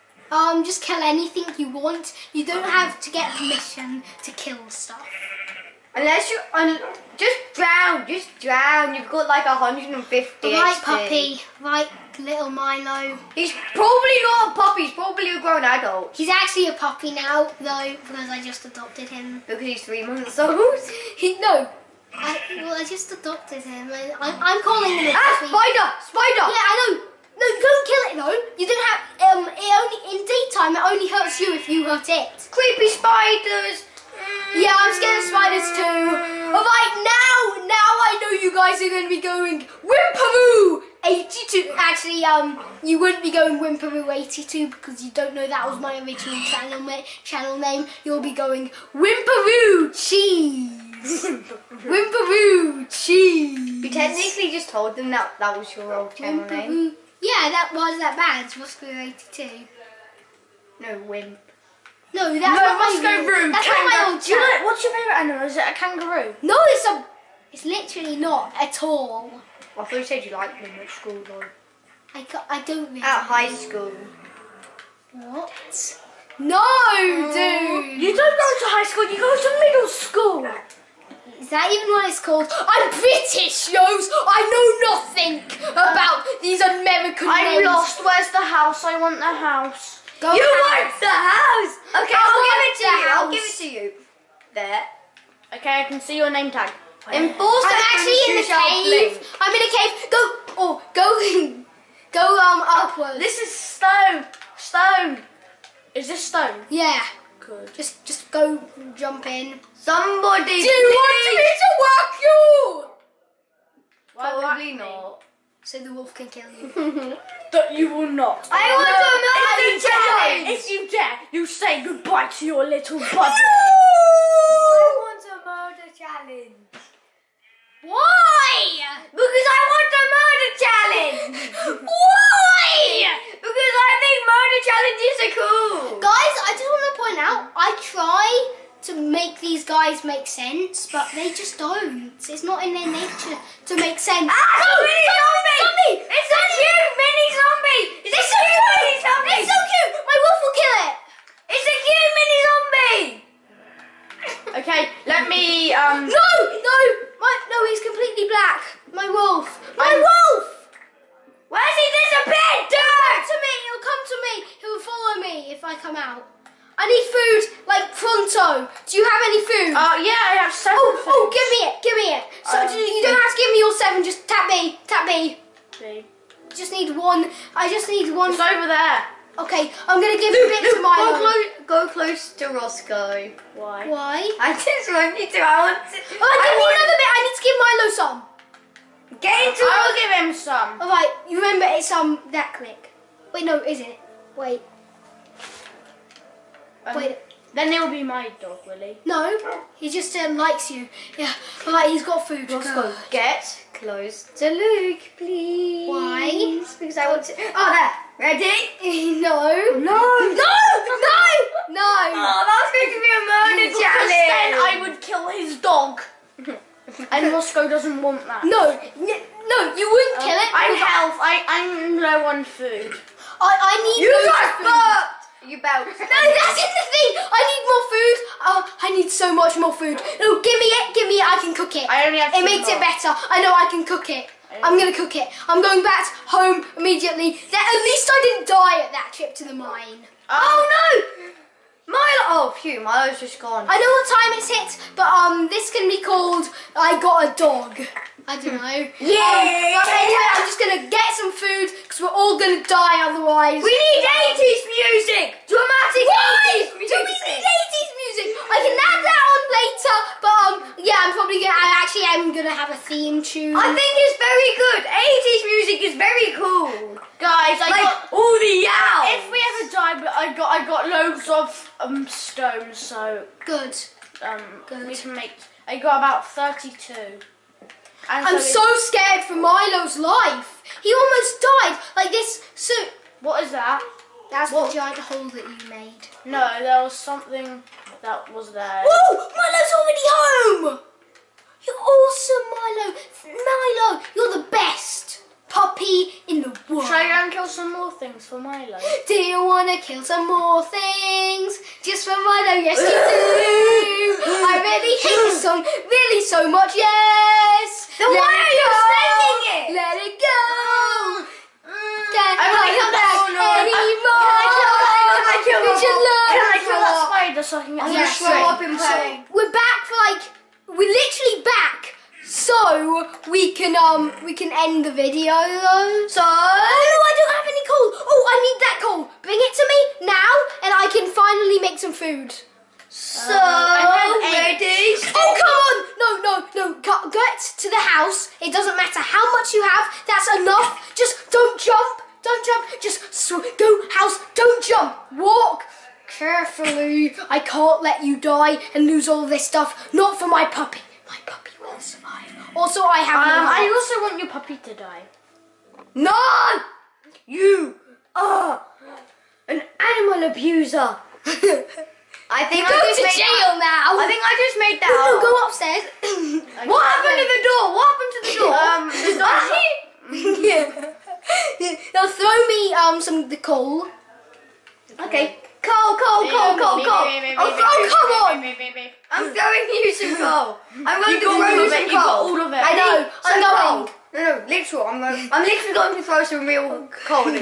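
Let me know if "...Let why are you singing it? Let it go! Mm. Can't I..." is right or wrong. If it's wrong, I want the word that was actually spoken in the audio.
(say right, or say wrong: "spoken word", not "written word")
right.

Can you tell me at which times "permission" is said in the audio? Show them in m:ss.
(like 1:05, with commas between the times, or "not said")
0:03.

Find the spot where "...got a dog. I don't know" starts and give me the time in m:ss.
4:07.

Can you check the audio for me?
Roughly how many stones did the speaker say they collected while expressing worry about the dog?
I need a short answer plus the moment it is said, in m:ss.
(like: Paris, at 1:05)
32, at 4:35.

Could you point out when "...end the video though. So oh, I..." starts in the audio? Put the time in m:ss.
5:24.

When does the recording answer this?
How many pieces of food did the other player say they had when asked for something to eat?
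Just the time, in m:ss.
2:50.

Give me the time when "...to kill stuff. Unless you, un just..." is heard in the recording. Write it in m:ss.
0:04.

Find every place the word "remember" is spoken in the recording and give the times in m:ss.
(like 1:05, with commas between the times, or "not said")
3:11.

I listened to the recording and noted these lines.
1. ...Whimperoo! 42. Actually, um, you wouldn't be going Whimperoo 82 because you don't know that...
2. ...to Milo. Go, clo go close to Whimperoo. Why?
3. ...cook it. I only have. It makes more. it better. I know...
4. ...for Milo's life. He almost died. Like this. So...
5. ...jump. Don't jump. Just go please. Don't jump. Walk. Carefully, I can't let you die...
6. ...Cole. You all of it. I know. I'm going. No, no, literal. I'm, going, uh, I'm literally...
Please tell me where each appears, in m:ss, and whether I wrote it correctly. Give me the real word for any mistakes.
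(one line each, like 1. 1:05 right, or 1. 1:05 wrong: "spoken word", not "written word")
1. 0:39 wrong: "82", not "42"
2. 3:00 wrong: "Roscoe", not "Whimperoo"
3. 3:51 right
4. 4:39 right
5. 5:41 wrong: "house", not "please"
6. 6:21 right.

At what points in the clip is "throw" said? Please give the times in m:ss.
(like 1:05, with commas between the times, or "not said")
6:12, 6:21, 6:26.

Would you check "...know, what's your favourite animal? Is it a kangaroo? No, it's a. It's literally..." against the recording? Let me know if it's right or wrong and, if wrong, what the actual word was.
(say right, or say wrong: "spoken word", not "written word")
right.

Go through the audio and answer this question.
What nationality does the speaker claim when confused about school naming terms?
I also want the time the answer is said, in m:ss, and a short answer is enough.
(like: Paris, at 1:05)
British, at 1:22.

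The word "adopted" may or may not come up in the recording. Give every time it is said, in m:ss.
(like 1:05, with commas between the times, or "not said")
0:18, 0:23.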